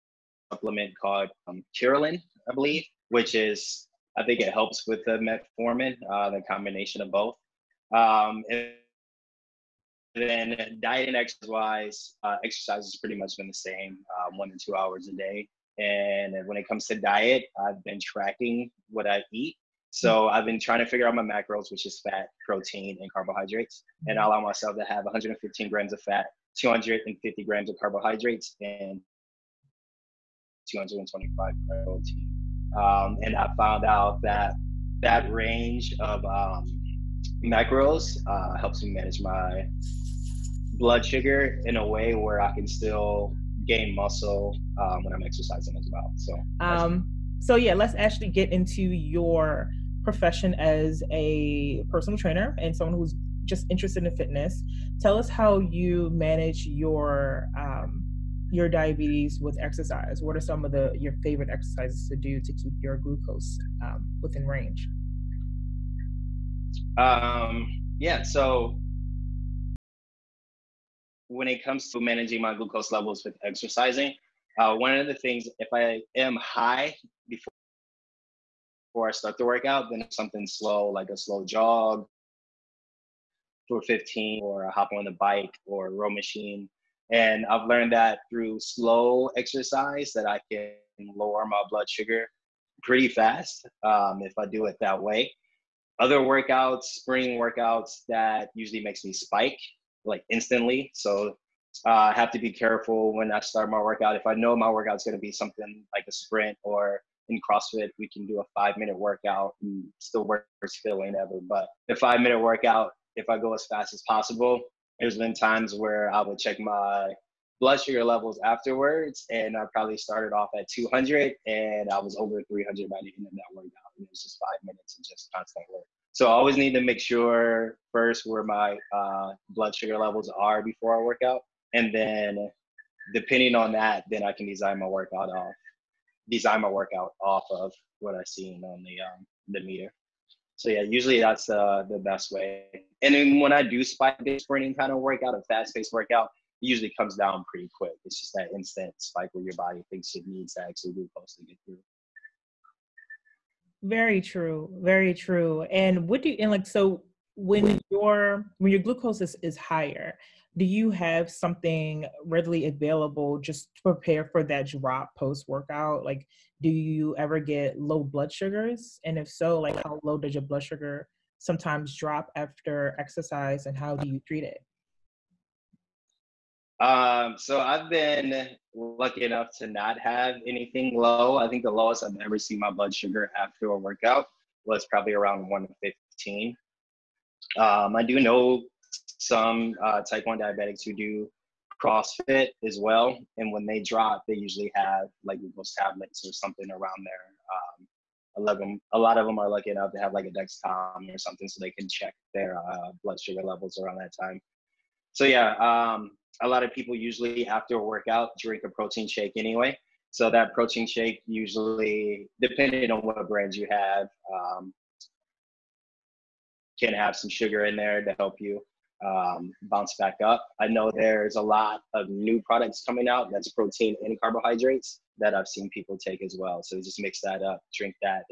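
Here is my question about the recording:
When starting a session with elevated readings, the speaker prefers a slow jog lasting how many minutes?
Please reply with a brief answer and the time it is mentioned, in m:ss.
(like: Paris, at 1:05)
15, at 1:23.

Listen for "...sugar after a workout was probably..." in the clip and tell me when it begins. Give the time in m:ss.
3:02.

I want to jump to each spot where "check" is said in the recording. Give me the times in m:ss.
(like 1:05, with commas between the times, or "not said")
1:56, 3:21.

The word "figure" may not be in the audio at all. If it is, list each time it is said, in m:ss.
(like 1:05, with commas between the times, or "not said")
0:20.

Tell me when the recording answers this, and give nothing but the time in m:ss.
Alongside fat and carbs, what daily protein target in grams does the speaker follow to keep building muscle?
0:30.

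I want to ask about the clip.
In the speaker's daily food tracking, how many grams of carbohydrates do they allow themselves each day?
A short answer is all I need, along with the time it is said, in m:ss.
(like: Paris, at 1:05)
250 grams, at 0:26.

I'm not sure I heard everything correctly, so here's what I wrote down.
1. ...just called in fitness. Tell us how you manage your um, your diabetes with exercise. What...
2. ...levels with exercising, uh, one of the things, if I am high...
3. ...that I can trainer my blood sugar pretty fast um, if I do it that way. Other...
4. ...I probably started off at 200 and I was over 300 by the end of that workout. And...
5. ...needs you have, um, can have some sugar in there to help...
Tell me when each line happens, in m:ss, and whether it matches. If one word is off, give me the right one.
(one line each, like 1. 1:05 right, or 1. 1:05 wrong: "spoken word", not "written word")
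1. 0:53 wrong: "interested", not "called"
2. 1:12 right
3. 1:30 wrong: "lower", not "trainer"
4. 1:59 right
5. 3:33 wrong: "brands", not "needs".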